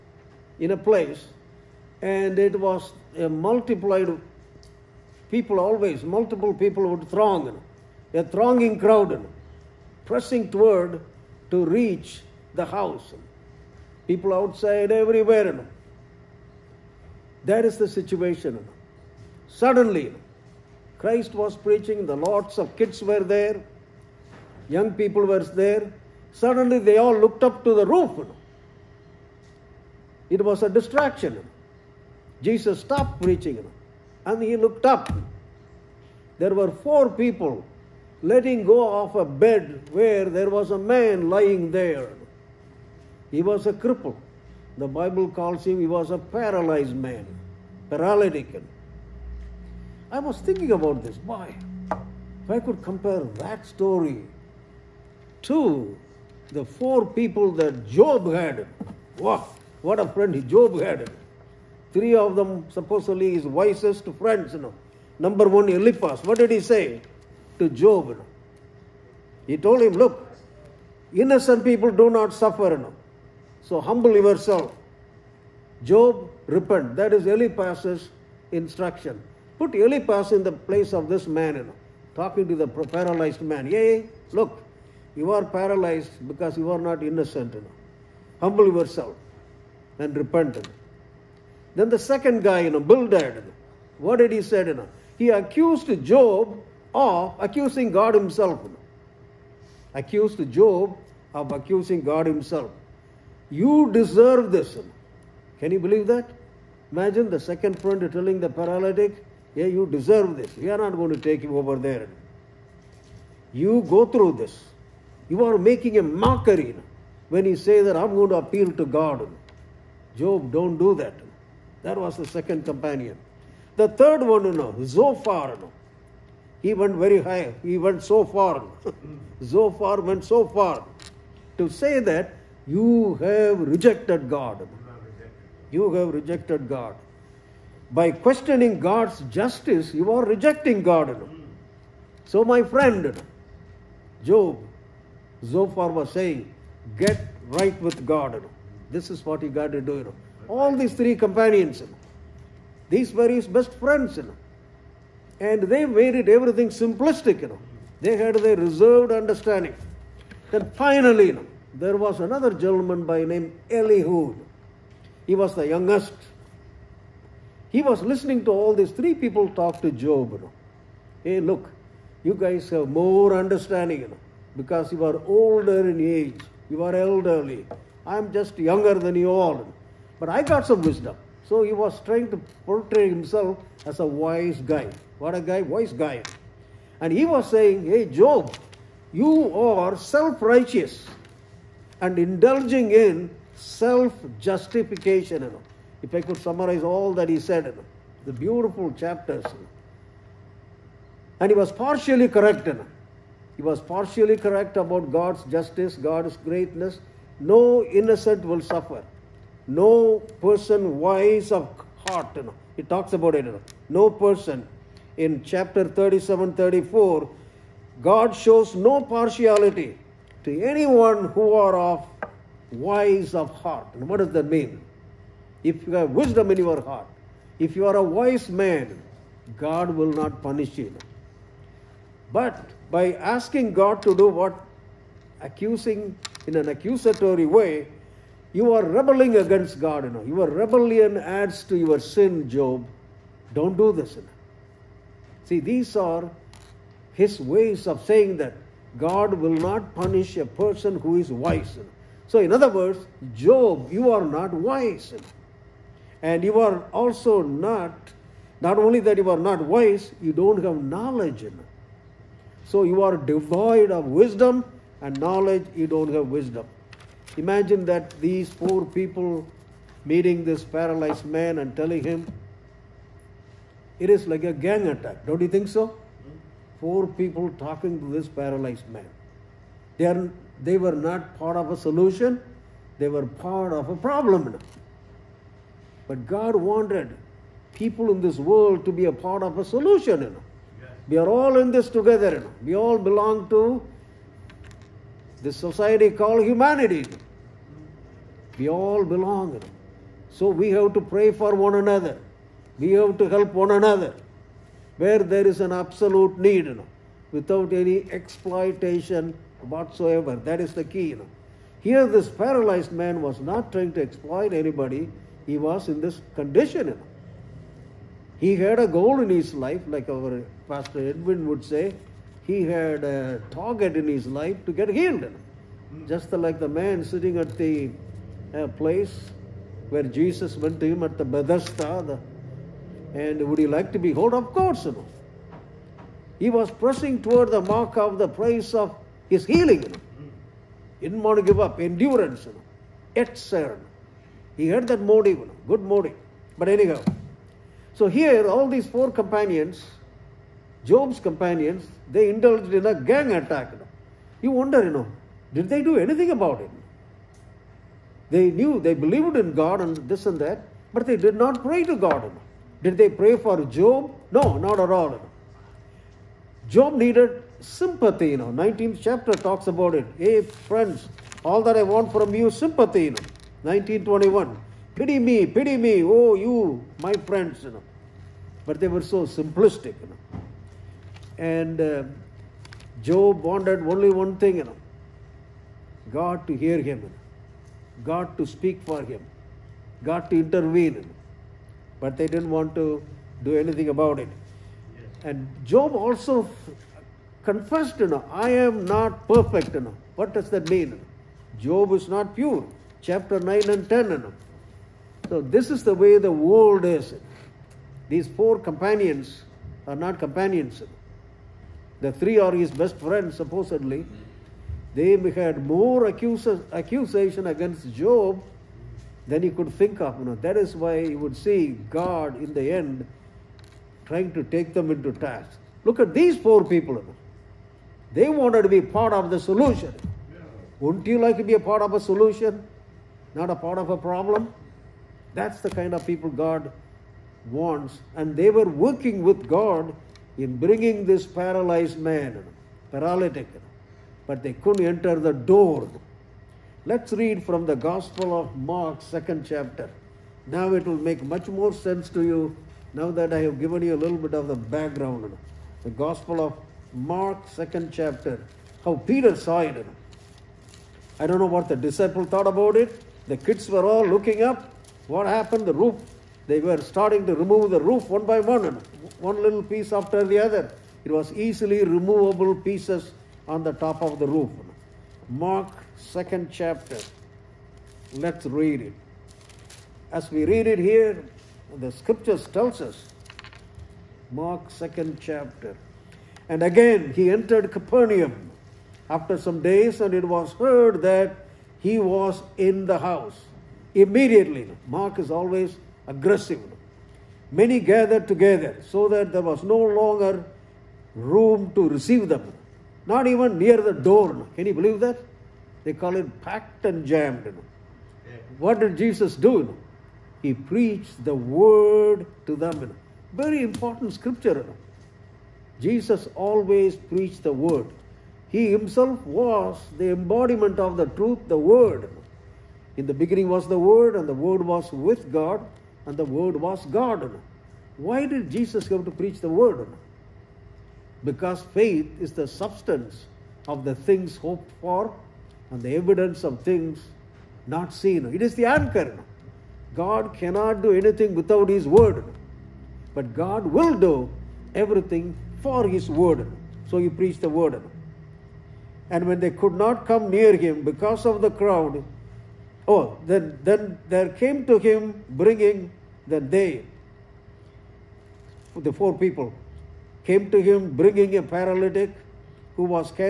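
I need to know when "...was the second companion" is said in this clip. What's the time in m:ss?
2:01.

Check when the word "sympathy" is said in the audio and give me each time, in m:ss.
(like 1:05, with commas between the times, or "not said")
6:07, 6:12.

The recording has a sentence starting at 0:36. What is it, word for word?
There were four people letting go of a bed where there was a man lying there.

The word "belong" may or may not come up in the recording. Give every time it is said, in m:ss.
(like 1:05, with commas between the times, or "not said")
4:52, 4:59.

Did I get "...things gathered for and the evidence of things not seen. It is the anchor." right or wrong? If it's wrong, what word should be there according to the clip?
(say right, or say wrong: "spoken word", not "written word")
wrong: "hoped", not "gathered".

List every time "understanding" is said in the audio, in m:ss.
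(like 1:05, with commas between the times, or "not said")
2:39, 2:53.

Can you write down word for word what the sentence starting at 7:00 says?
You know, that is why you would see God in the end trying to take them into task.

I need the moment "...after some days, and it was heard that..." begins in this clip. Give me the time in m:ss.
8:09.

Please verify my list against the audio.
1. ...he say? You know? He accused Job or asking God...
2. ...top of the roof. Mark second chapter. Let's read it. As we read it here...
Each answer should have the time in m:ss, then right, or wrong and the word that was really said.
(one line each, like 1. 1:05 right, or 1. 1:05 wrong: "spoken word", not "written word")
1. 1:34 wrong: "accusing", not "asking"
2. 7:53 right.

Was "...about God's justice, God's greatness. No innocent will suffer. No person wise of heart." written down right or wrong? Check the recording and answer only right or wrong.
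right.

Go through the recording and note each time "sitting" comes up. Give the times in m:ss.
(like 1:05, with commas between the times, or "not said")
5:27.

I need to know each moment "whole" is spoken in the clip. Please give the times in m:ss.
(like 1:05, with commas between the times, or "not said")
not said.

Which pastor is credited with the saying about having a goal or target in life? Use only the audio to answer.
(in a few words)
Pastor Edwin.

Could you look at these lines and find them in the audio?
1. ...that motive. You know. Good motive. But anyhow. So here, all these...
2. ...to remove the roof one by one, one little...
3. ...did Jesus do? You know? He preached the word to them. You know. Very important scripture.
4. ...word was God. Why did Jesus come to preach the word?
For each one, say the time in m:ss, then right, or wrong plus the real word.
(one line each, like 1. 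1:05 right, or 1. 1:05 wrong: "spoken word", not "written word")
1. 5:44 right
2. 7:47 right
3. 8:28 right
4. 8:46 right.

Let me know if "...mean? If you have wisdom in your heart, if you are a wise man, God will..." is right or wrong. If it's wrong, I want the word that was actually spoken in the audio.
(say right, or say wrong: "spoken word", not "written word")
right.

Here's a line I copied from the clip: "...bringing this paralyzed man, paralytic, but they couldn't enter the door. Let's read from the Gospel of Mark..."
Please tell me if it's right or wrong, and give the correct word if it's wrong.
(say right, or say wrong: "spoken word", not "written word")
right.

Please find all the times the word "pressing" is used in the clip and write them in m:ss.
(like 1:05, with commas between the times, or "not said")
0:10, 5:36.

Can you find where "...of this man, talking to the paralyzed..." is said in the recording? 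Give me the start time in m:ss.
1:20.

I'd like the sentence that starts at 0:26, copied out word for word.
Suddenly, they all looked up to the roof.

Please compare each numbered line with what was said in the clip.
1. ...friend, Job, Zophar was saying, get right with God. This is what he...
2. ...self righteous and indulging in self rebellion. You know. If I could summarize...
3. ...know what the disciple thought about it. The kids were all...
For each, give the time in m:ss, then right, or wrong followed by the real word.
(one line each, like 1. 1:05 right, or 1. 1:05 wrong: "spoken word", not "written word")
1. 2:22 right
2. 3:09 wrong: "justification", not "rebellion"
3. 7:41 right.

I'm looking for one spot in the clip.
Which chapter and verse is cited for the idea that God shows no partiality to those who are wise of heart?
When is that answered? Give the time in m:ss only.
3:35.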